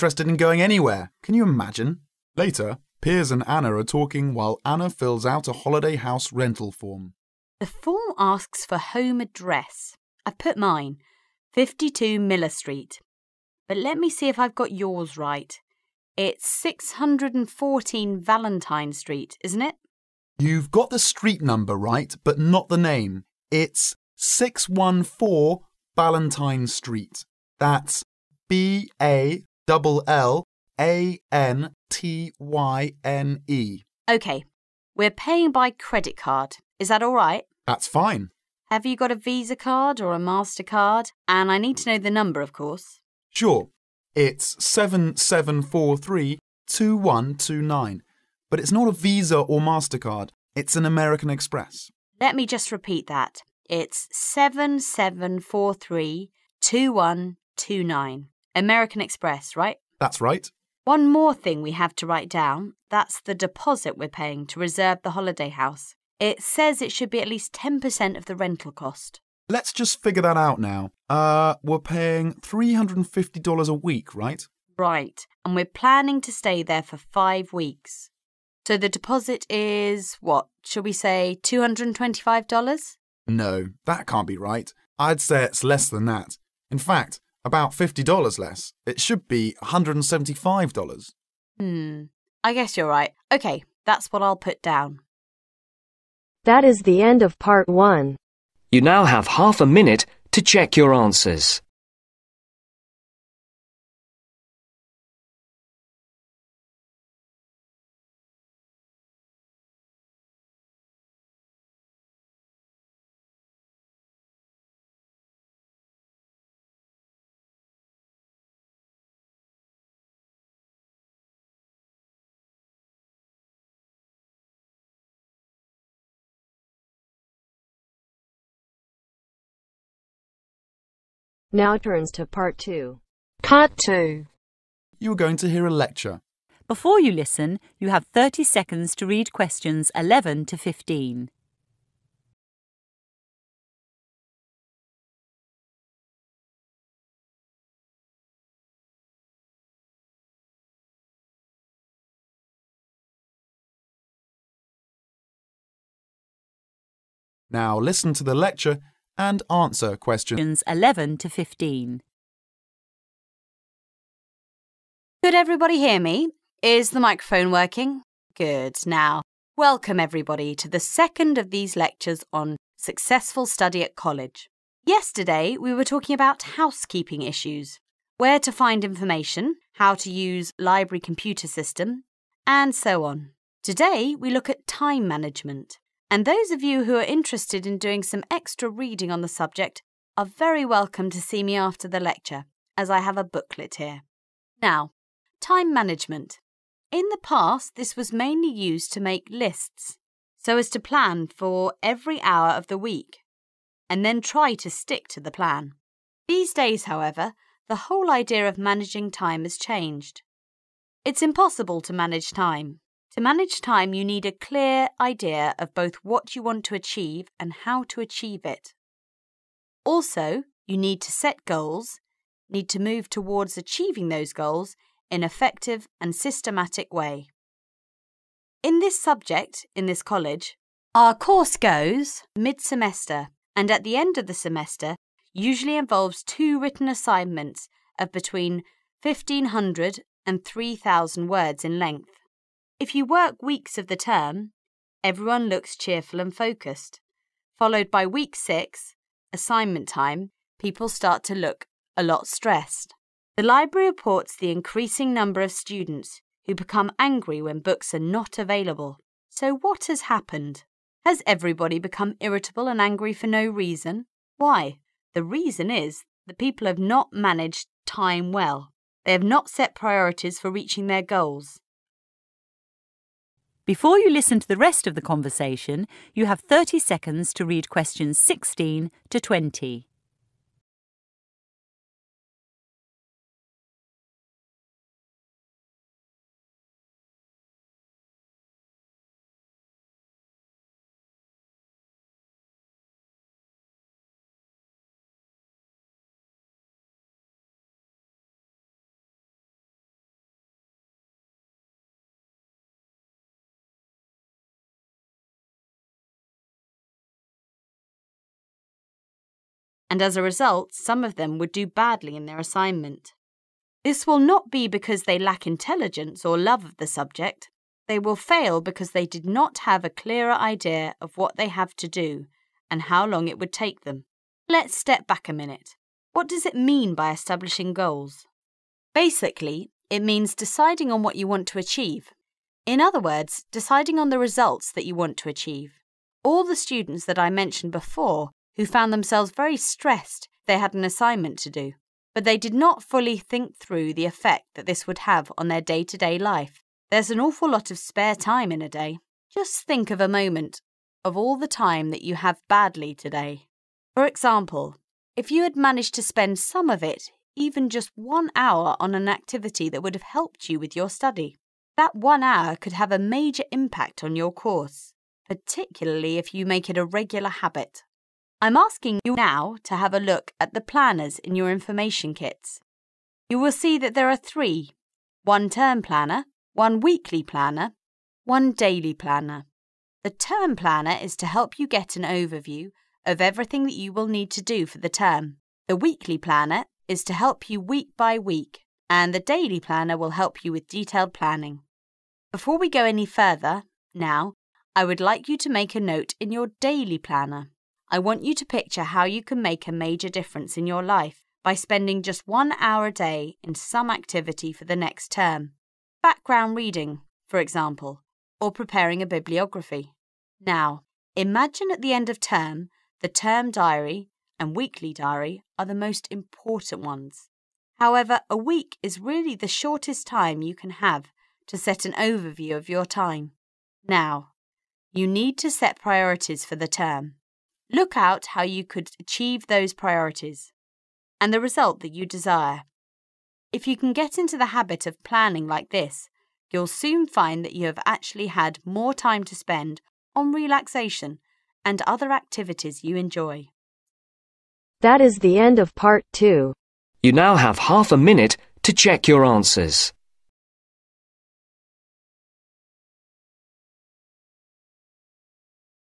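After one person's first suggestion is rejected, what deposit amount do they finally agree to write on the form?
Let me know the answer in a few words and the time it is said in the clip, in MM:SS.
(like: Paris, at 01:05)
$175, at 01:29.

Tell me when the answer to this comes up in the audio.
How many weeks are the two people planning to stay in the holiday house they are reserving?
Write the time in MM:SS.
01:16.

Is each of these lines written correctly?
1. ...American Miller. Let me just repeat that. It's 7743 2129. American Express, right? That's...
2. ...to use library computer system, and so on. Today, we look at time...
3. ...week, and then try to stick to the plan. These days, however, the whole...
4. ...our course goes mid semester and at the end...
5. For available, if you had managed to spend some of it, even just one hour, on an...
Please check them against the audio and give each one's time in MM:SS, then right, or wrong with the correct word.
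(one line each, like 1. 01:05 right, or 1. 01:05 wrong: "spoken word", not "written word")
1. 00:50 wrong: "Express", not "Miller"
2. 02:59 right
3. 03:22 right
4. 03:50 right
5. 05:53 wrong: "example", not "available".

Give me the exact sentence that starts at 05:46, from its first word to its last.
There's an awful lot of spare time in a day.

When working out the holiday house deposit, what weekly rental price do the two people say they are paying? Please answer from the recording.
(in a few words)
$350.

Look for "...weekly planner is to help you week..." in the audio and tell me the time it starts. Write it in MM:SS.
06:25.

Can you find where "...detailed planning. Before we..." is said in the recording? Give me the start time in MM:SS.
06:30.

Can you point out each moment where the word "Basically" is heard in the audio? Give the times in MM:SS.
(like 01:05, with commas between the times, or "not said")
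05:28.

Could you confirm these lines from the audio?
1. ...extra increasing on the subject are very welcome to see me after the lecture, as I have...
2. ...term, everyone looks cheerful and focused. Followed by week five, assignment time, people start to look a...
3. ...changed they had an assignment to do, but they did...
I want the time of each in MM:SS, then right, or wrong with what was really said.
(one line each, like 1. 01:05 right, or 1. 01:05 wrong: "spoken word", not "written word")
1. 03:08 wrong: "reading", not "increasing"
2. 04:03 wrong: "six", not "five"
3. 05:39 wrong: "stressed", not "changed".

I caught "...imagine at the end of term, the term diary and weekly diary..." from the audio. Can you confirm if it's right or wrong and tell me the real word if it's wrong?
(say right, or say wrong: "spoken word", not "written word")
right.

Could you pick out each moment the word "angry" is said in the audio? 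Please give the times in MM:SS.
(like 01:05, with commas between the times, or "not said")
04:16, 04:22.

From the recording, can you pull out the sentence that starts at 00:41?
And I need to know the number, of course.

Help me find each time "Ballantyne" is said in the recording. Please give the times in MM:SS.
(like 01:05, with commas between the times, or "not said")
00:25.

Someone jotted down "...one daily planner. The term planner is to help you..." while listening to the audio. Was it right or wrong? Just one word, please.
right.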